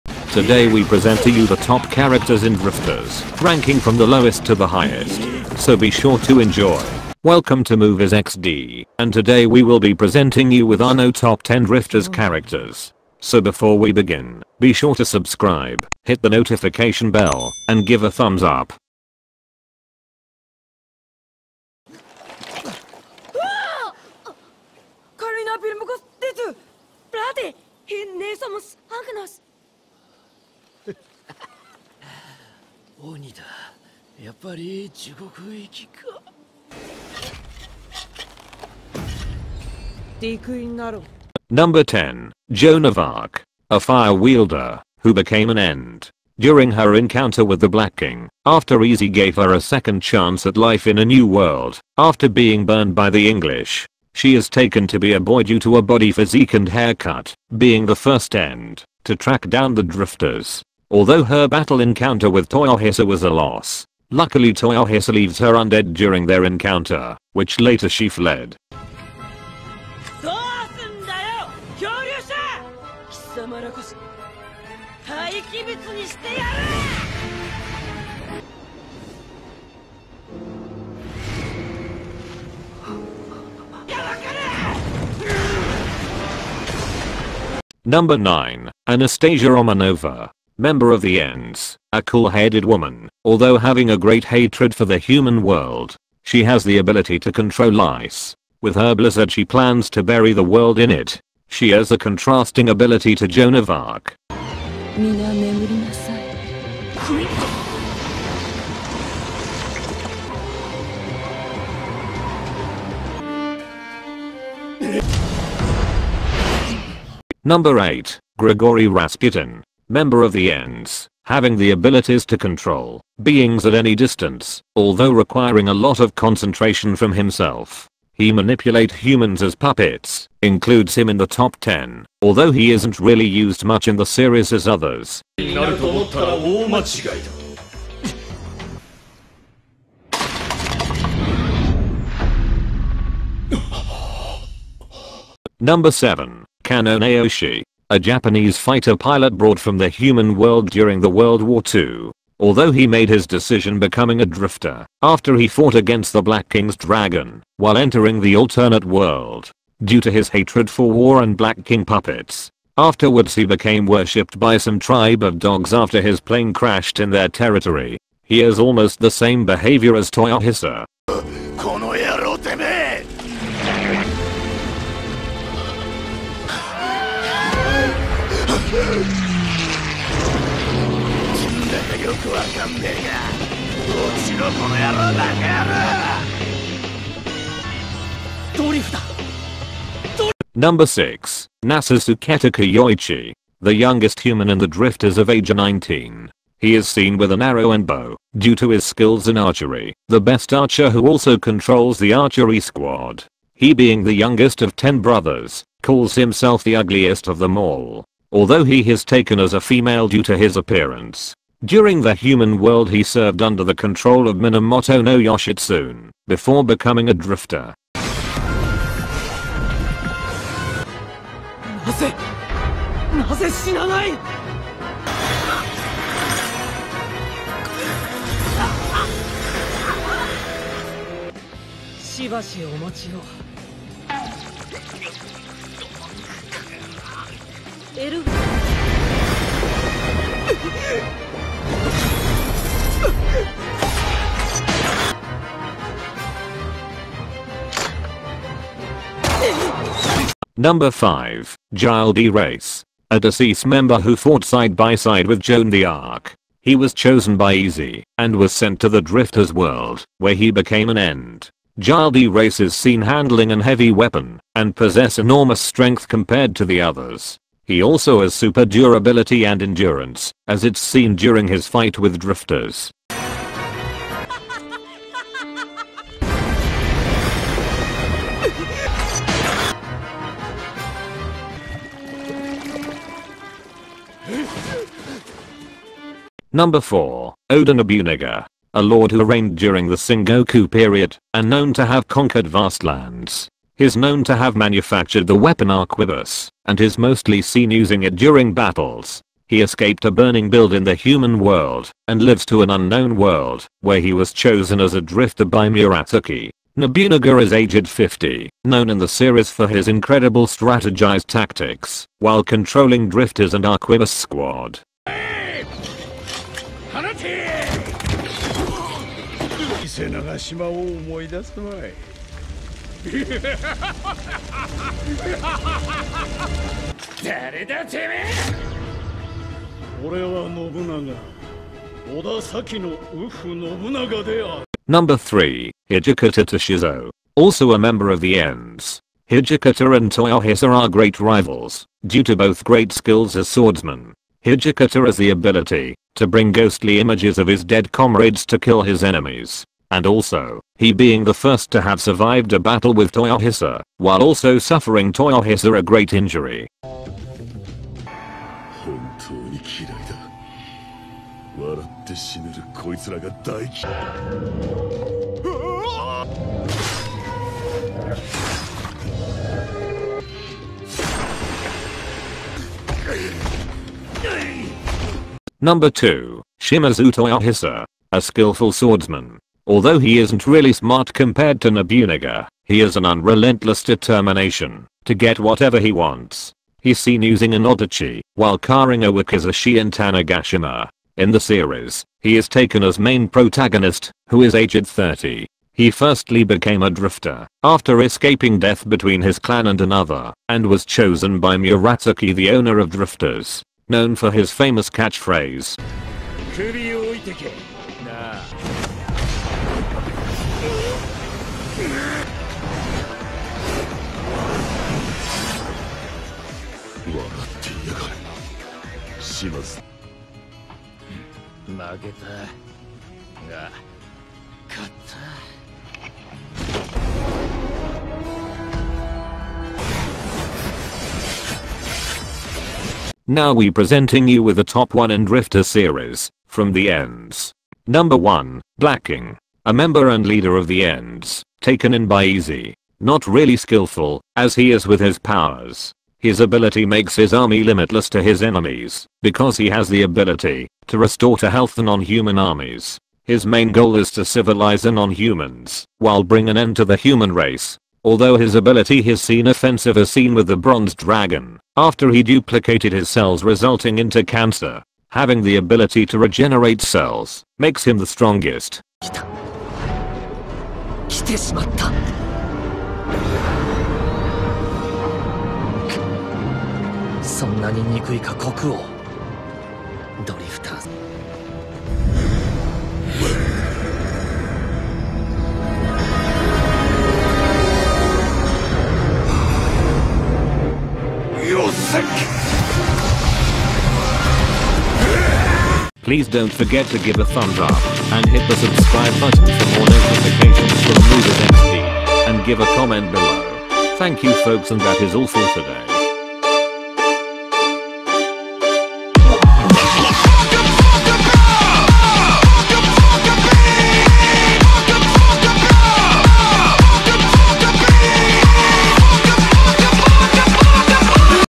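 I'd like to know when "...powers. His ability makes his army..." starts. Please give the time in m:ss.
7:25.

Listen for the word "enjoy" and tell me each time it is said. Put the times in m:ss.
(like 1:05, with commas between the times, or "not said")
0:06.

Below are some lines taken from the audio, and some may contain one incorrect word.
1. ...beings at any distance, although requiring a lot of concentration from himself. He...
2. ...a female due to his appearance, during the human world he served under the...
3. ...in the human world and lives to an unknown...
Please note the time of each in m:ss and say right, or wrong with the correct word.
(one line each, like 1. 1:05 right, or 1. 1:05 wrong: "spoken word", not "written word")
1. 2:03 right
2. 3:29 right
3. 5:00 right.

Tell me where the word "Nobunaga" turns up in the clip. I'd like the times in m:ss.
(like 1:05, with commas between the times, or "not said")
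4:47, 5:06, 6:21.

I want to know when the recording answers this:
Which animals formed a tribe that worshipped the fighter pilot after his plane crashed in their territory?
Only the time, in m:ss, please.
2:45.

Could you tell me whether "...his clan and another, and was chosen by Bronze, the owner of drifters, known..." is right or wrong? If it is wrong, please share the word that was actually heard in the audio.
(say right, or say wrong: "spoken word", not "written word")
wrong: "Murasaki", not "Bronze".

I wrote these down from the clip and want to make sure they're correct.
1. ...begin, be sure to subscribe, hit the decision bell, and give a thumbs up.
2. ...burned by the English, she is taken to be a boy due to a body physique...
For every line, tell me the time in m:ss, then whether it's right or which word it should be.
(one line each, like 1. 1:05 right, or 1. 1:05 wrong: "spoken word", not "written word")
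1. 0:13 wrong: "notification", not "decision"
2. 0:52 right.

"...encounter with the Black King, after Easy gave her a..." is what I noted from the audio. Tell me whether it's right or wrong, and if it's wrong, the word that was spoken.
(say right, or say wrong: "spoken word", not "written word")
right.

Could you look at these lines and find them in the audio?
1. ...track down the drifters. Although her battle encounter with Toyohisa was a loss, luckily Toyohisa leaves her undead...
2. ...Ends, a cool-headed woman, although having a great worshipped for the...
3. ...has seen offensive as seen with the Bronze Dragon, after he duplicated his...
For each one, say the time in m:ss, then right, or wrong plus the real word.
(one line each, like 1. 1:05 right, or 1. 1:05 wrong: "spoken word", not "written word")
1. 0:59 right
2. 1:31 wrong: "hatred", not "worshipped"
3. 7:39 right.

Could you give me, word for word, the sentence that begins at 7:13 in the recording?
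Now we presenting you with the top 1 and Rifter series, from the ends.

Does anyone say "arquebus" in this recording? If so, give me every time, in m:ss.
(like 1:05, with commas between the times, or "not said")
4:55, 5:13.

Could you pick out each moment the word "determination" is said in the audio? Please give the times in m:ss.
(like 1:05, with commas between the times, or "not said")
6:23.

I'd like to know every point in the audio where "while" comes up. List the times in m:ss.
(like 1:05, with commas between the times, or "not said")
2:37, 5:12, 5:53, 6:28, 7:35.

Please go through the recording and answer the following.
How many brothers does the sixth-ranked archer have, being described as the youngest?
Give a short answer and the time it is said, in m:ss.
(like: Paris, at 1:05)
10, at 3:24.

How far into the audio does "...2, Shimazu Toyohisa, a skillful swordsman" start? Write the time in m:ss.
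6:15.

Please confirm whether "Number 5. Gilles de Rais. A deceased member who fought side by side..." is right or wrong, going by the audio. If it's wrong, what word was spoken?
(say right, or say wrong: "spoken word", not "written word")
right.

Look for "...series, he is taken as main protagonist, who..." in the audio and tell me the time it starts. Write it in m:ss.
6:31.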